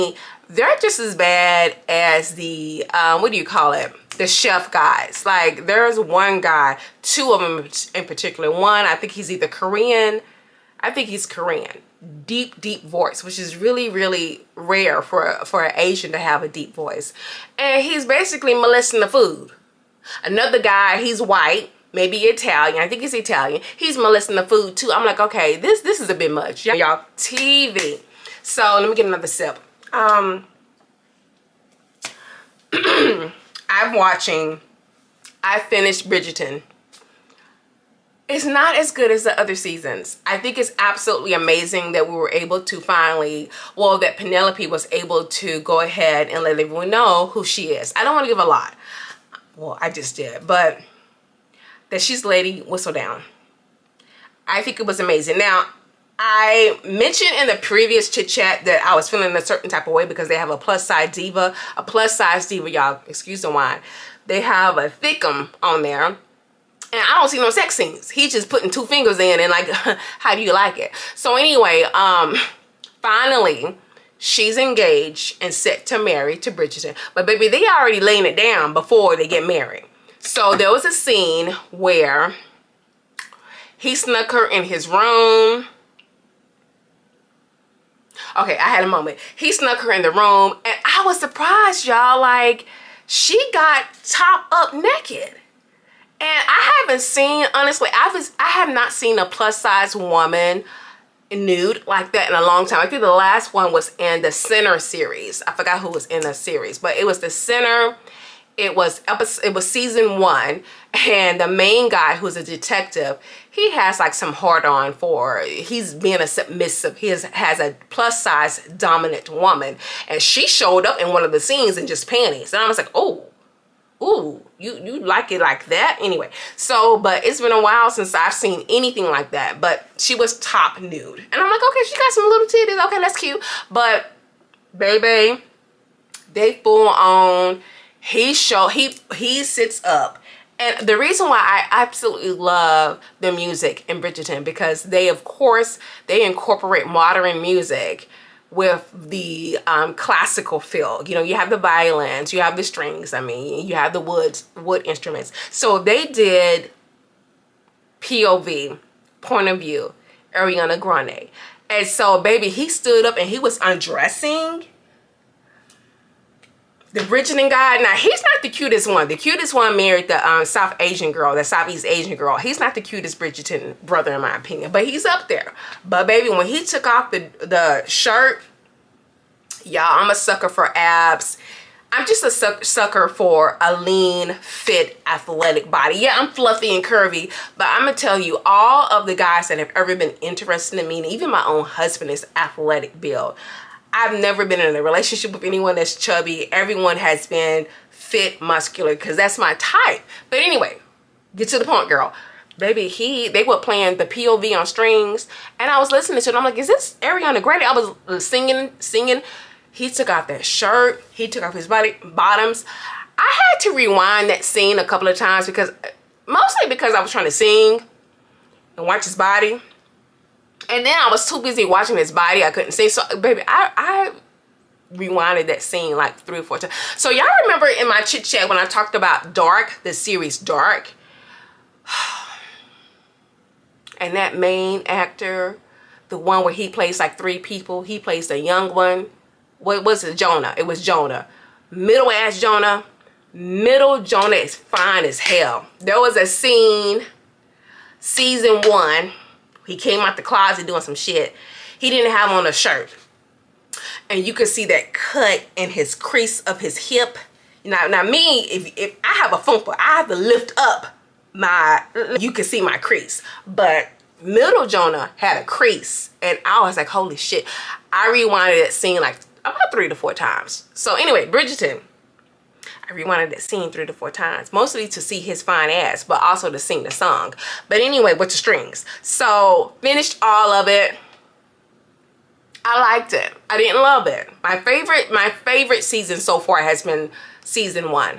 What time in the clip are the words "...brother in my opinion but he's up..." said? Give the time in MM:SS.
02:53.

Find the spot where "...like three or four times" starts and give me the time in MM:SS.
03:45.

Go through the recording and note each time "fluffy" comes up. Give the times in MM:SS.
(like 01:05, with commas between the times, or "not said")
03:06.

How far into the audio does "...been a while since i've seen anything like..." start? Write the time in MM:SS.
02:07.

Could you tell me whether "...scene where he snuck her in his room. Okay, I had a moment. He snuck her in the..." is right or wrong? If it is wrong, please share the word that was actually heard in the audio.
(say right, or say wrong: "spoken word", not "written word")
right.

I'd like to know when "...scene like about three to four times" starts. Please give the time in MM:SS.
04:28.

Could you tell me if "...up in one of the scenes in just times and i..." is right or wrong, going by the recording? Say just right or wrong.
wrong.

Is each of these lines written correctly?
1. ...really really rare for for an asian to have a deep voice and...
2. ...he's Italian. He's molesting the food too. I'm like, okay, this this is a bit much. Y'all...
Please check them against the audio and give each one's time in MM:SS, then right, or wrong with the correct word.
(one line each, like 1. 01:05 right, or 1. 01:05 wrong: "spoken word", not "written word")
1. 00:13 right
2. 00:23 right.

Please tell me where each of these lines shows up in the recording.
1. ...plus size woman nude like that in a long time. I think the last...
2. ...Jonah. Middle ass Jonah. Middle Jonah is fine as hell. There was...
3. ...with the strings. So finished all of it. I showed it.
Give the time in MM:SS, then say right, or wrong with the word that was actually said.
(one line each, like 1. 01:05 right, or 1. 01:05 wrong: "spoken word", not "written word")
1. 01:39 right
2. 04:00 right
3. 04:38 wrong: "liked", not "showed".